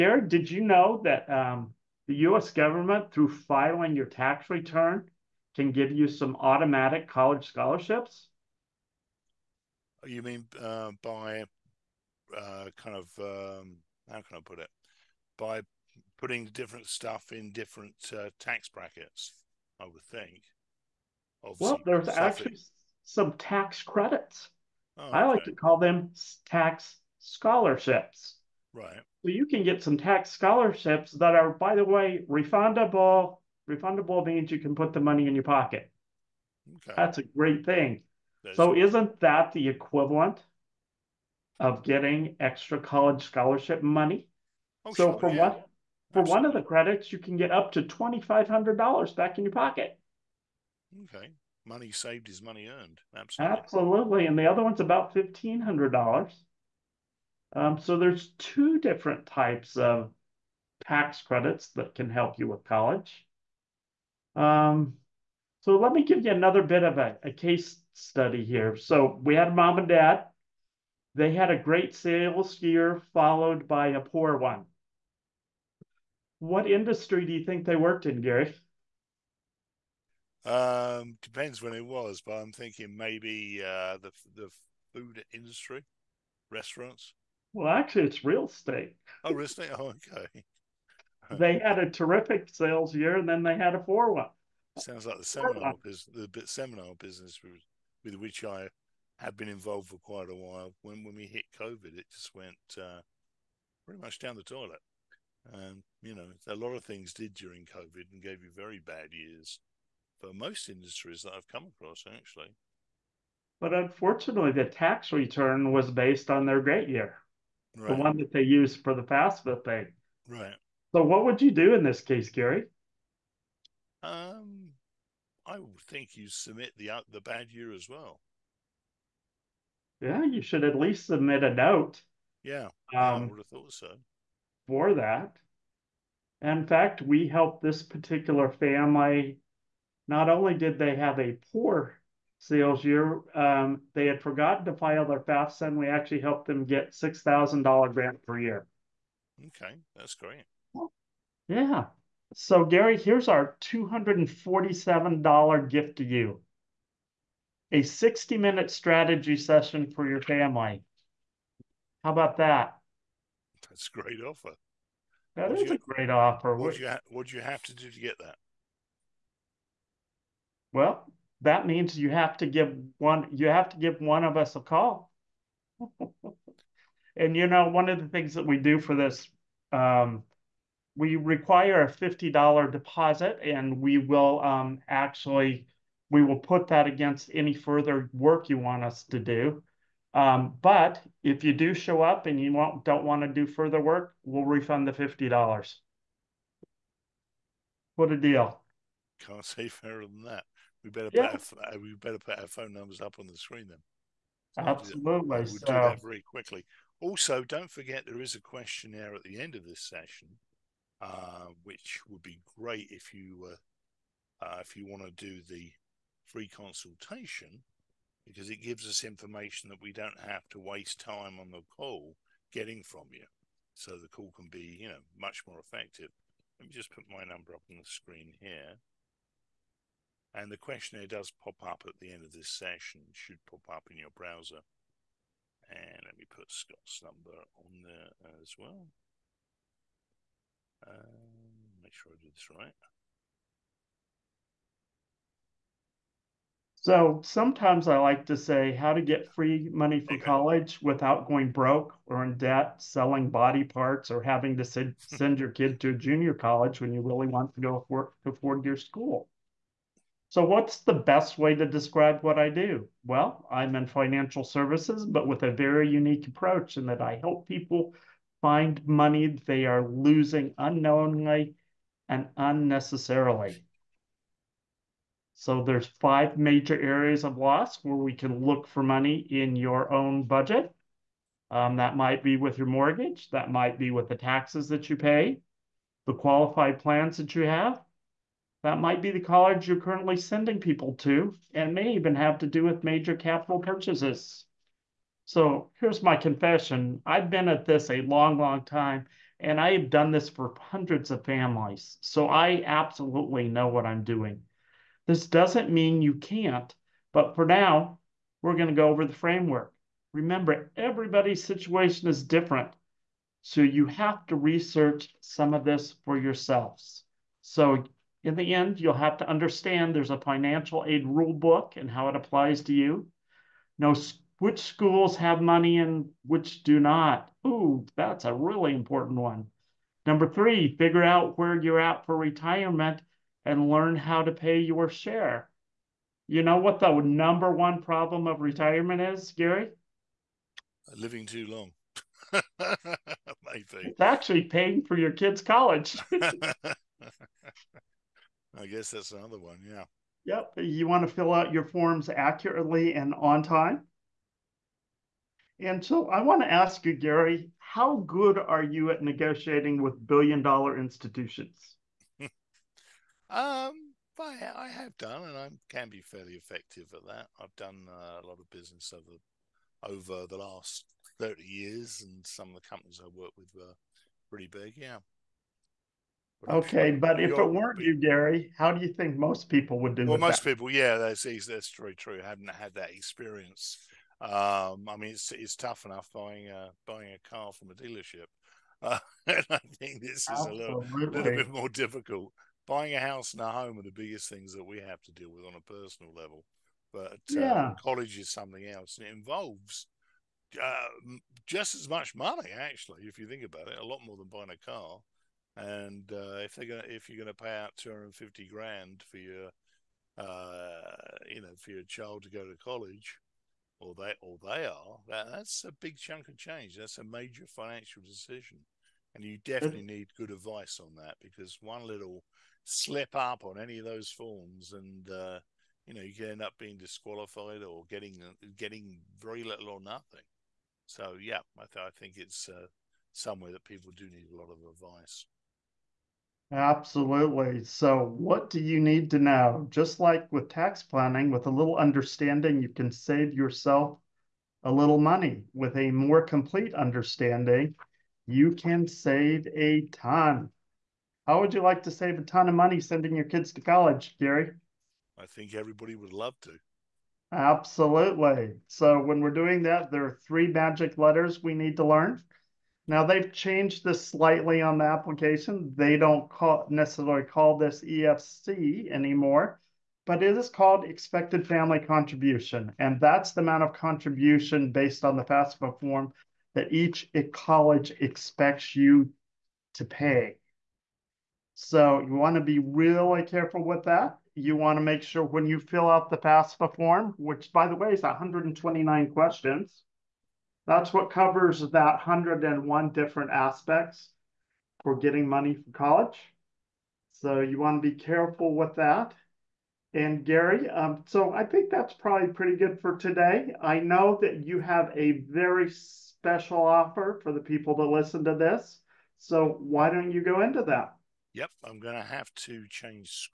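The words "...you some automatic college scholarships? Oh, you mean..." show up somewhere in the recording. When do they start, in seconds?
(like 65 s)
5 s.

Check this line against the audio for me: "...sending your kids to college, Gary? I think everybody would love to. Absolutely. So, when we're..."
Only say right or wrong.
right.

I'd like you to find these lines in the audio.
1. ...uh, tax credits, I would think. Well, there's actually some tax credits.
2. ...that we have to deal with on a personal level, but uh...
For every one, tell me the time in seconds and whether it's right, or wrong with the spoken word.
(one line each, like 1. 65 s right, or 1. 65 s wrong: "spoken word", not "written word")
1. 18 s wrong: "brackets", not "credits"
2. 394 s right.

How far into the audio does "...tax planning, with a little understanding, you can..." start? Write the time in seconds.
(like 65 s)
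440 s.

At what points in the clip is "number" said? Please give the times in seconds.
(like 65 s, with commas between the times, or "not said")
202 s, 227 s, 237 s, 330 s, 336 s.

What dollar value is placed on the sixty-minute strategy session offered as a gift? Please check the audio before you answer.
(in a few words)
$247.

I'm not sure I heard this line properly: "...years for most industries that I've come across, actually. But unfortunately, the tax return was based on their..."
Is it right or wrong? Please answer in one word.
right.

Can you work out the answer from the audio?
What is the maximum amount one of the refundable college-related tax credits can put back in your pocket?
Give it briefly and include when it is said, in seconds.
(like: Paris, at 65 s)
$2,500, at 47 s.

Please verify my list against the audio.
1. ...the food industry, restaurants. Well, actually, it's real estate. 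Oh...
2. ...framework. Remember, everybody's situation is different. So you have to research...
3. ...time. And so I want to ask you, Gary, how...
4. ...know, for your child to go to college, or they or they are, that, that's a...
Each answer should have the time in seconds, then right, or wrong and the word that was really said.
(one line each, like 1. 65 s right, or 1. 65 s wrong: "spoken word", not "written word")
1. 84 s right
2. 309 s right
3. 353 s right
4. 411 s right.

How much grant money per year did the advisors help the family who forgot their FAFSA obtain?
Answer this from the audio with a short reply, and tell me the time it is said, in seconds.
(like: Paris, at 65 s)
$6,000, at 146 s.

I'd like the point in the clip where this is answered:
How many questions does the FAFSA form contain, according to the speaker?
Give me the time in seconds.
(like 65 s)
488 s.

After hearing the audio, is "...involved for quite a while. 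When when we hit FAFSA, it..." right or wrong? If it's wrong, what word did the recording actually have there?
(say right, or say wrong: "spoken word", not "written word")
wrong: "COVID", not "FAFSA".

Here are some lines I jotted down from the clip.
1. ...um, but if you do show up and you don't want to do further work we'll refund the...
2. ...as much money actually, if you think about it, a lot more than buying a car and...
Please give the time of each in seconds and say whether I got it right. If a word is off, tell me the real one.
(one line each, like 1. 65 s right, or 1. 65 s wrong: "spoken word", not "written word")
1. 190 s right
2. 401 s right.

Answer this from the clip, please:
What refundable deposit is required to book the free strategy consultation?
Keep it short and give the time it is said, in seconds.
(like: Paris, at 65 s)
$50, at 181 s.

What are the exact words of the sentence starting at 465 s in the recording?
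They don't call, necessarily call this EFC anymore, but it is called expected family contribution.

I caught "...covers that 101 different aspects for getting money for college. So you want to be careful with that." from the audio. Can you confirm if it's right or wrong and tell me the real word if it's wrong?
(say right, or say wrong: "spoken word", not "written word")
right.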